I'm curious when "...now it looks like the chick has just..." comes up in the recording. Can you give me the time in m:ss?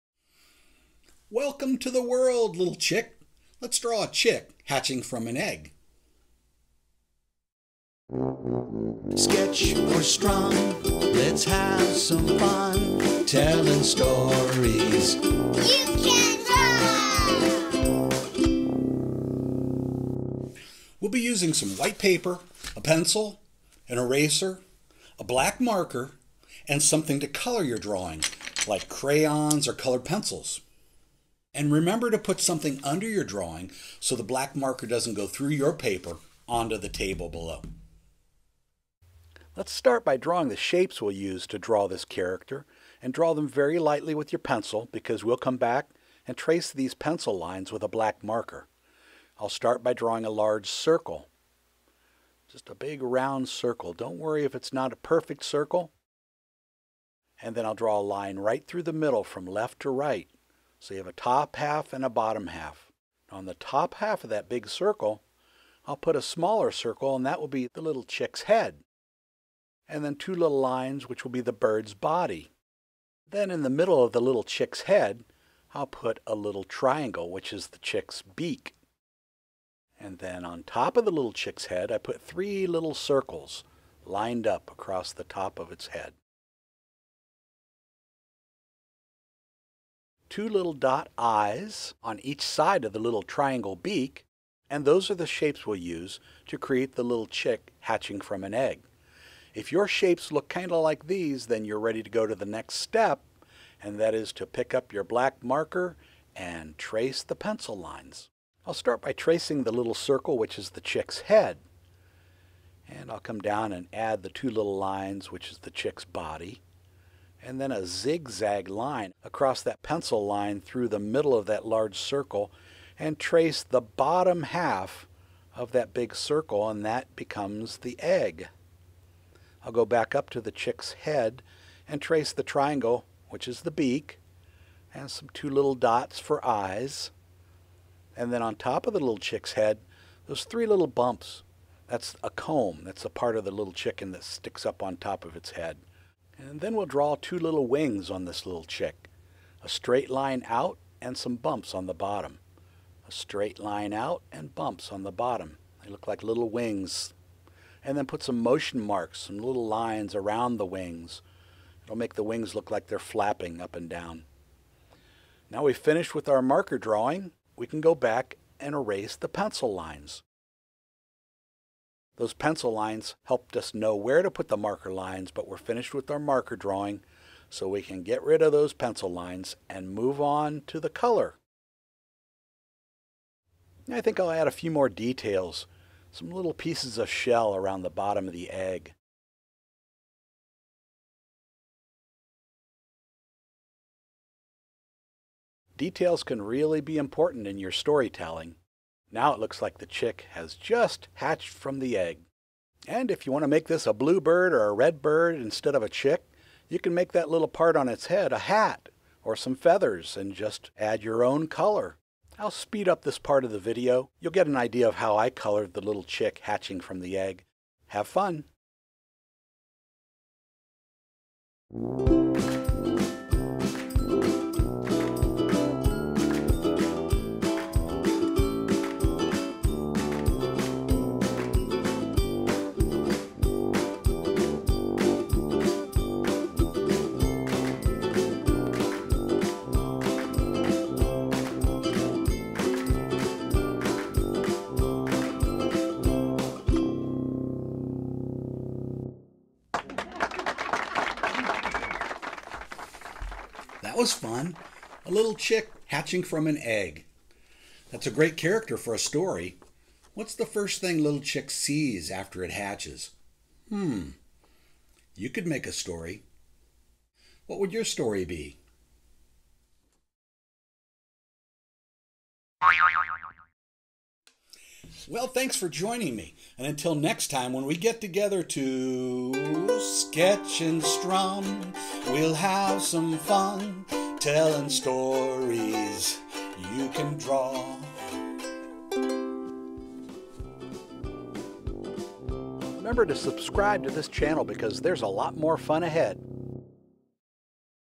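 3:19.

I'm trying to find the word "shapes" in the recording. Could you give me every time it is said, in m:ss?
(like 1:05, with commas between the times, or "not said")
0:40, 1:35, 1:39.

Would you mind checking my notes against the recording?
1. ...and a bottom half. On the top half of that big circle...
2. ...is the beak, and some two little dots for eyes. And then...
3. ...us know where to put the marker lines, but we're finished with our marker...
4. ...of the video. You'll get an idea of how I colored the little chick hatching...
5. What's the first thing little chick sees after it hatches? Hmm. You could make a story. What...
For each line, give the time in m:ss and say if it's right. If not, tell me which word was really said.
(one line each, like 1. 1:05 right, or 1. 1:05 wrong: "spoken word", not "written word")
1. 1:01 right
2. 2:13 right
3. 2:53 right
4. 3:33 right
5. 4:20 right.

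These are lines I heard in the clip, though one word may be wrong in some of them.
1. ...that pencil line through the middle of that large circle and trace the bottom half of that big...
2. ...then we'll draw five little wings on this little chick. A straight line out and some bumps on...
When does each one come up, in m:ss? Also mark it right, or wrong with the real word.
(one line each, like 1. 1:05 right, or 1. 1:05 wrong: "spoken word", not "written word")
1. 1:59 right
2. 2:26 wrong: "two", not "five".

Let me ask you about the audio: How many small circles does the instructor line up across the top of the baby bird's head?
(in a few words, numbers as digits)
3.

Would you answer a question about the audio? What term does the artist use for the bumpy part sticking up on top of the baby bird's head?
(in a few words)
comb.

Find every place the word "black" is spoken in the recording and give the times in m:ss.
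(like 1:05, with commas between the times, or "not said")
0:25, 0:34, 0:47, 1:45.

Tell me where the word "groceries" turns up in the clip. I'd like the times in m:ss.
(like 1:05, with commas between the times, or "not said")
not said.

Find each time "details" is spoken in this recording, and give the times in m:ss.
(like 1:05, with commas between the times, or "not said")
3:04, 3:15.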